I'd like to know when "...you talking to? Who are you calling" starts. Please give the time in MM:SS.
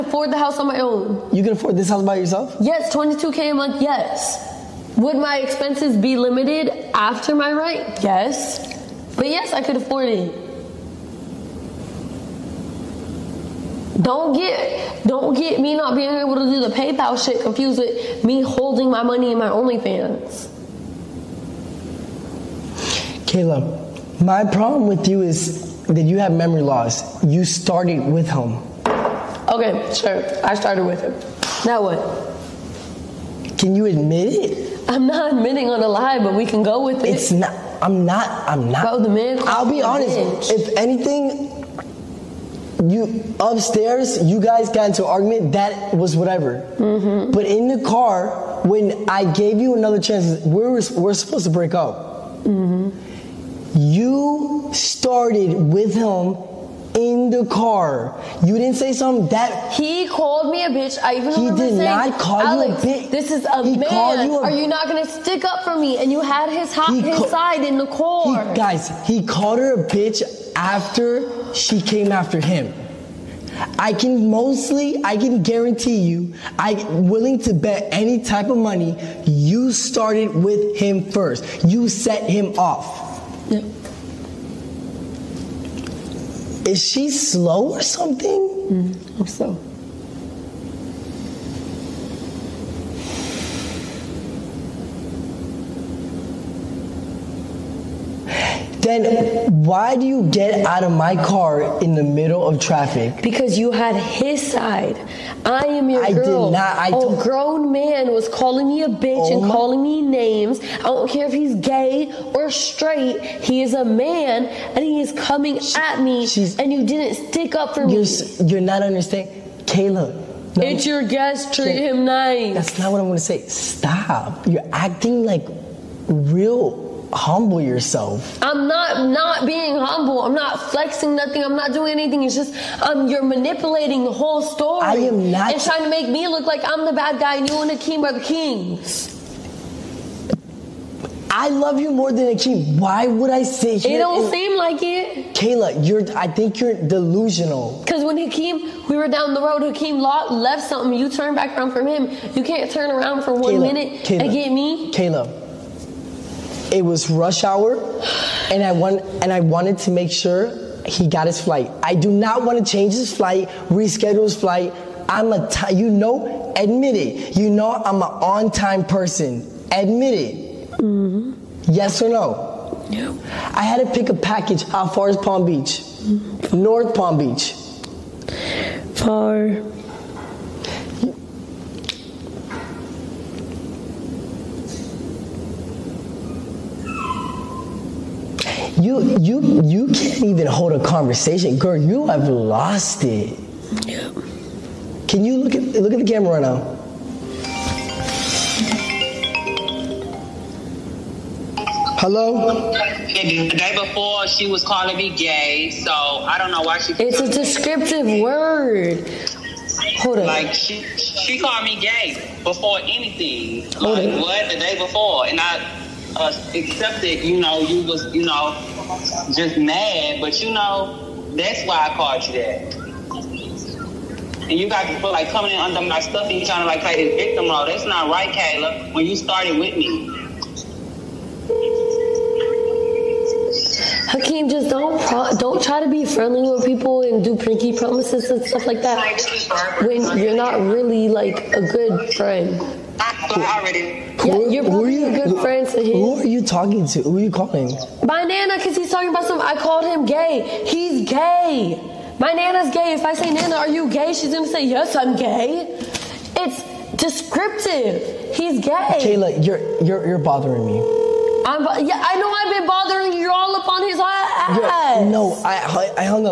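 04:06.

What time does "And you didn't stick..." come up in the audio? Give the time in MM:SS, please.
01:56.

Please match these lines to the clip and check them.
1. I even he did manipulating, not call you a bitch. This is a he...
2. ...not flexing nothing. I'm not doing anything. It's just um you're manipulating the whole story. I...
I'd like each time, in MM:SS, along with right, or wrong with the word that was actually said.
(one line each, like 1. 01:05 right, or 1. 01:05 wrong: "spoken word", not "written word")
1. 01:01 wrong: "saying", not "manipulating"
2. 02:10 right.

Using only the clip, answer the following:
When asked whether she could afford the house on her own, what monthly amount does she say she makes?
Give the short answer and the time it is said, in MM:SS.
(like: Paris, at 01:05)
22K, at 00:02.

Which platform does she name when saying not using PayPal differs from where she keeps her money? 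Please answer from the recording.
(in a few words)
OnlyFans.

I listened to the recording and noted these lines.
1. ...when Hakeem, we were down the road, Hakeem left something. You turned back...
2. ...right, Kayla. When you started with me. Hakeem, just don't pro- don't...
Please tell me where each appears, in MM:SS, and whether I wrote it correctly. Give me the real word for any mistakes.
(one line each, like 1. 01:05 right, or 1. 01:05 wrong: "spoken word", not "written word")
1. 02:28 right
2. 03:48 right.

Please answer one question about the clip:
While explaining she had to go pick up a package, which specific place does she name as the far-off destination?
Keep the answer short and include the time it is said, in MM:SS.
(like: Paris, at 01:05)
North Palm Beach, at 02:56.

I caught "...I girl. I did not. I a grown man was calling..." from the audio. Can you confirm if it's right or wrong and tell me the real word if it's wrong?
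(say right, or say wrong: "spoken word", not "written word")
right.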